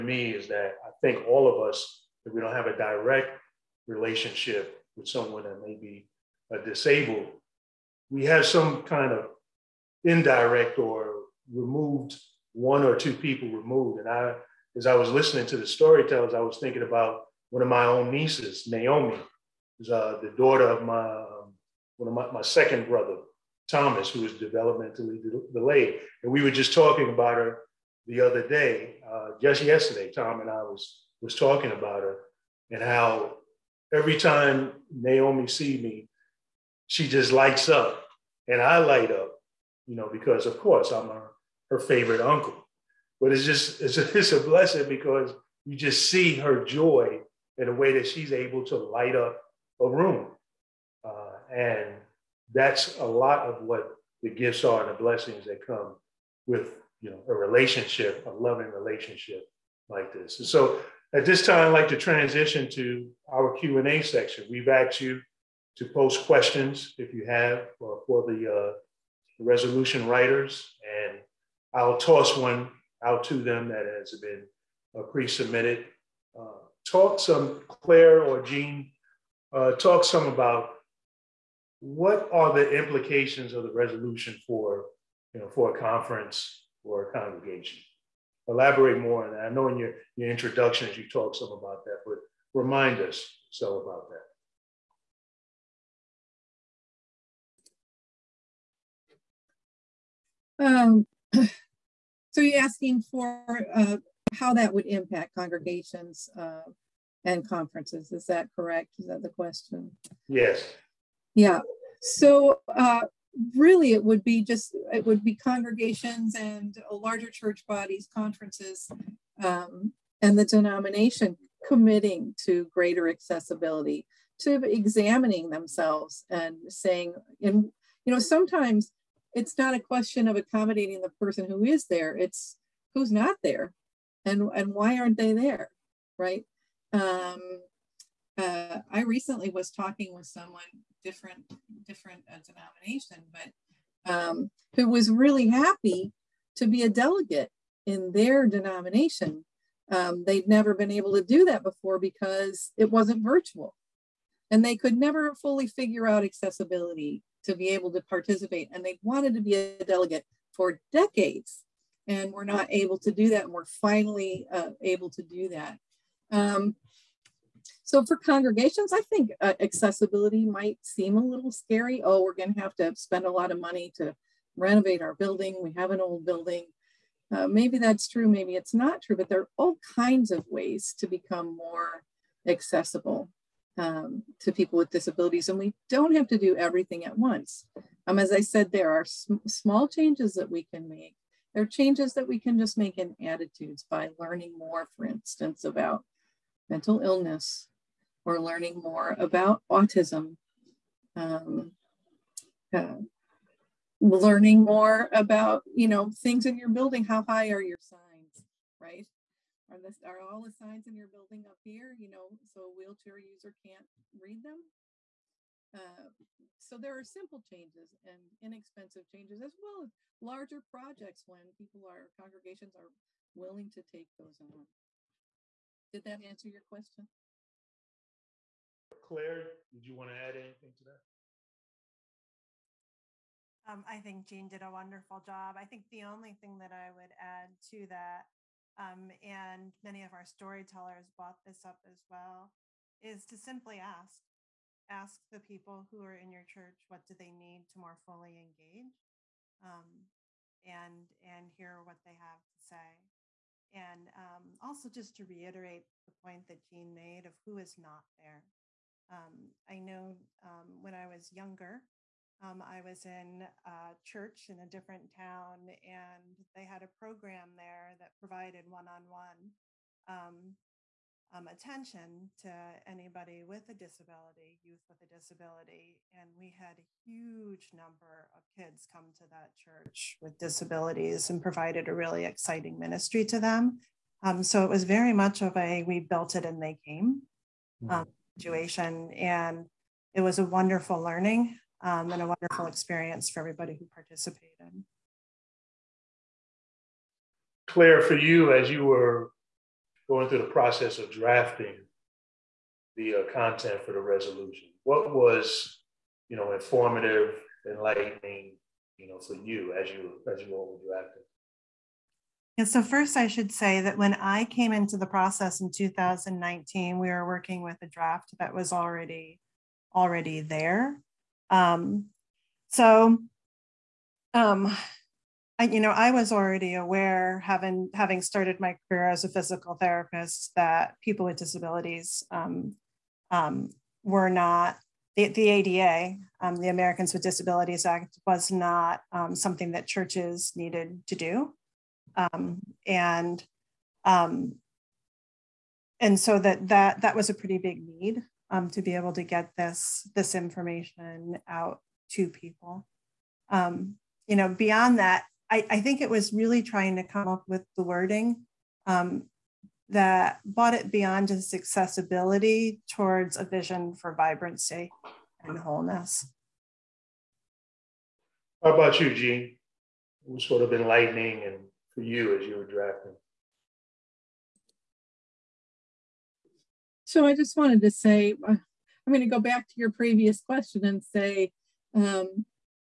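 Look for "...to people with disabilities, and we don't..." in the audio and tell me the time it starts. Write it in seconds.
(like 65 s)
184 s.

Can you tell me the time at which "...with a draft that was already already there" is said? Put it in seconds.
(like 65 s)
317 s.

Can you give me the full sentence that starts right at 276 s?
And we had a huge number of kids come to that church with disabilities and provided a really exciting ministry to them.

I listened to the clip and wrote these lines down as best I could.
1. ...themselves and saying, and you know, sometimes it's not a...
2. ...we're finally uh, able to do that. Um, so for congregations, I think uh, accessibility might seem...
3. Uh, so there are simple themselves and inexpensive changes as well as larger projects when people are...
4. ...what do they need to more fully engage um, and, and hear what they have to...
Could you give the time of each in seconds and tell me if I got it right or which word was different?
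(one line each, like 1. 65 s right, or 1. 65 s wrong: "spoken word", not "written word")
1. 125 s right
2. 163 s right
3. 215 s wrong: "changes", not "themselves"
4. 246 s right.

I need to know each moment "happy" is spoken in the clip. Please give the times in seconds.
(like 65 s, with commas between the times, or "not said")
145 s.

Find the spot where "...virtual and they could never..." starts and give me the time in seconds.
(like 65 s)
153 s.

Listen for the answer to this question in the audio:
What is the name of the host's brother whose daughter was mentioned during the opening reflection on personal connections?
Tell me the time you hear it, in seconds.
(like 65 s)
23 s.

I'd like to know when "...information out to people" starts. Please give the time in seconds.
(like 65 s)
350 s.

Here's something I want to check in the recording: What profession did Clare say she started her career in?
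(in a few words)
Physical therapist.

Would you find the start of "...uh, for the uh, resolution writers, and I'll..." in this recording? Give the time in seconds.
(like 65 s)
67 s.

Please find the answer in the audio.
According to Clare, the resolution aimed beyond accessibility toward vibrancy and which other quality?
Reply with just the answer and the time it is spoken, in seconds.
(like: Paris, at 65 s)
Wholeness, at 365 s.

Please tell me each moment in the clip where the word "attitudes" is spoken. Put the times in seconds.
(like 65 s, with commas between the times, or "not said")
193 s.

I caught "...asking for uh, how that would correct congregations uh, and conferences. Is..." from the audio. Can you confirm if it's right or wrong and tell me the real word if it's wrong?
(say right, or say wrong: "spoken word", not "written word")
wrong: "impact", not "correct".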